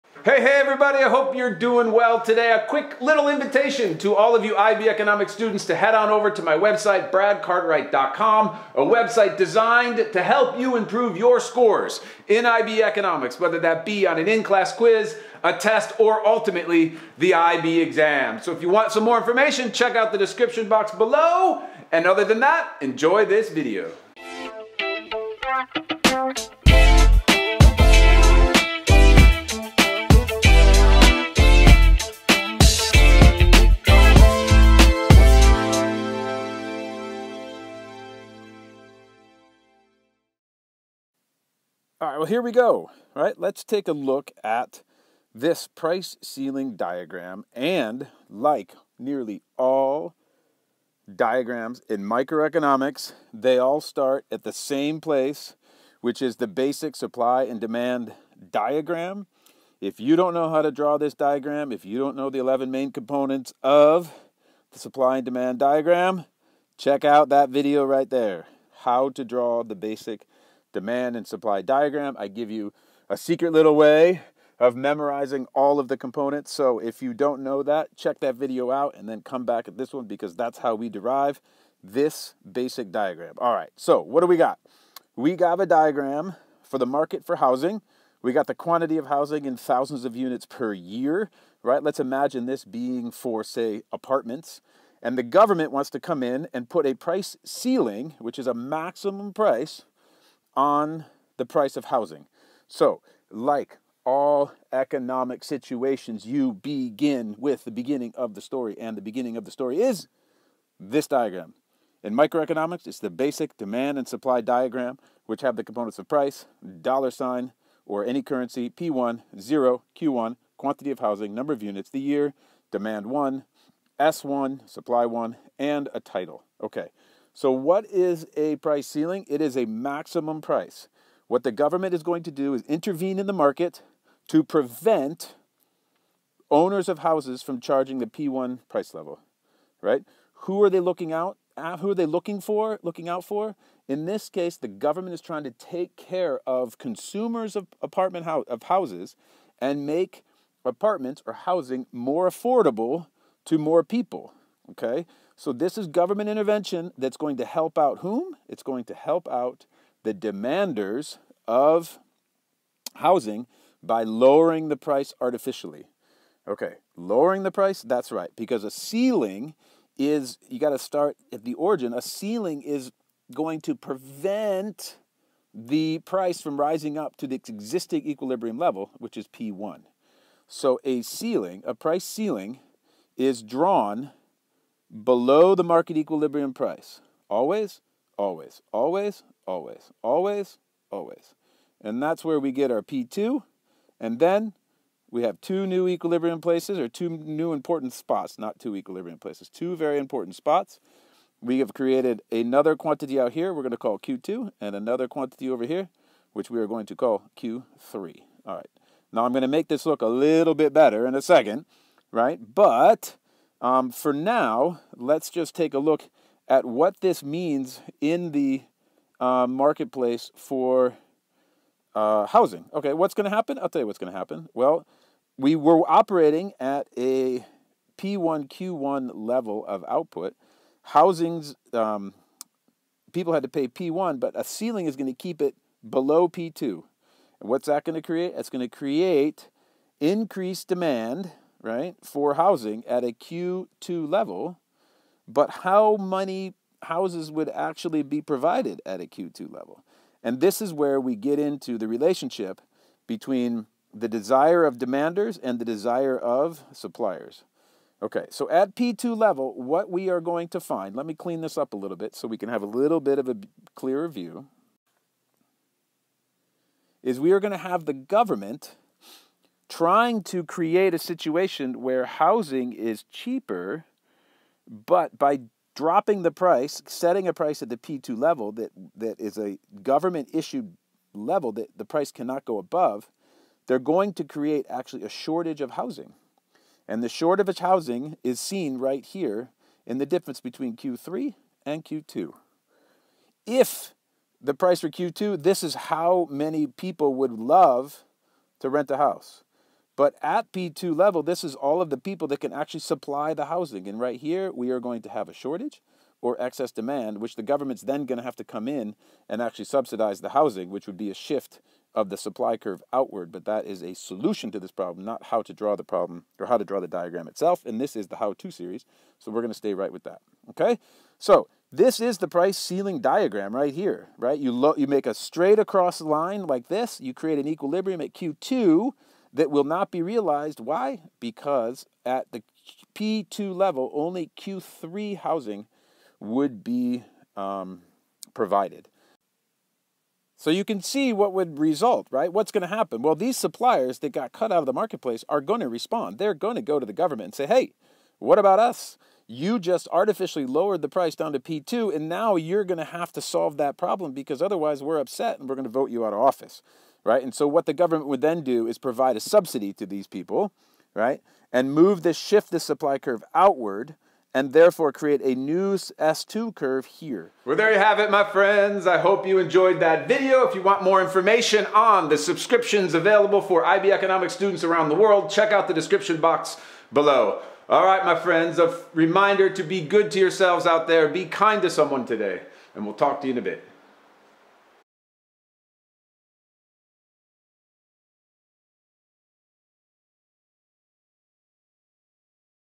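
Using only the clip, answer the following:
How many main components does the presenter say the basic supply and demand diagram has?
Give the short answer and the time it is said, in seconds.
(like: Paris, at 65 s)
11, at 62 s.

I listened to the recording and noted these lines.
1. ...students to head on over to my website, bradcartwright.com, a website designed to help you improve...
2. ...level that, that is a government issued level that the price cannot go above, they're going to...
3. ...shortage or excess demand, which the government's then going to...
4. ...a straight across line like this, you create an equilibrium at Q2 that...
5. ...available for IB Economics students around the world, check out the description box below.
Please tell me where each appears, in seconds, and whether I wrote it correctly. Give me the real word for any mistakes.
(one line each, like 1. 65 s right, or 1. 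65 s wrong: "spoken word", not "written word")
1. 5 s right
2. 278 s right
3. 305 s right
4. 325 s right
5. 372 s right.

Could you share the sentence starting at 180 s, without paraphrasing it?
So a ceiling, a price ceiling, is drawn below the market equilibrium price.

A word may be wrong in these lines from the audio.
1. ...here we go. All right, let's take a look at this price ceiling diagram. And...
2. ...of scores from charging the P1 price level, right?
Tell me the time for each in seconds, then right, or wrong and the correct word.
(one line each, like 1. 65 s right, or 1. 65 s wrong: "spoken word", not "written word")
1. 42 s right
2. 136 s wrong: "houses", not "scores".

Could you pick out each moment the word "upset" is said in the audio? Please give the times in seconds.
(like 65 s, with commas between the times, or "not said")
354 s.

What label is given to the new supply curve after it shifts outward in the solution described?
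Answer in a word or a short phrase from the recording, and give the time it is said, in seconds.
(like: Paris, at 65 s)
S2, at 365 s.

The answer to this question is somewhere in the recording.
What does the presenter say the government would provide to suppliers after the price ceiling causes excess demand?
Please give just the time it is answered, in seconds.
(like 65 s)
359 s.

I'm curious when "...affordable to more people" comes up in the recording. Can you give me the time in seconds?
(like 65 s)
152 s.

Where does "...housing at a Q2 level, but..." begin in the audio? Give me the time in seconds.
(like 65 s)
242 s.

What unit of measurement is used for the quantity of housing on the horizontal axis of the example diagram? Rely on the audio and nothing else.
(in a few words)
thousands of units per year.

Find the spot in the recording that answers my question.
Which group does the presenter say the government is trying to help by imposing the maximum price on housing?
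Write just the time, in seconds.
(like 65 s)
160 s.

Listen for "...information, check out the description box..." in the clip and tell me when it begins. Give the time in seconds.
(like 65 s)
19 s.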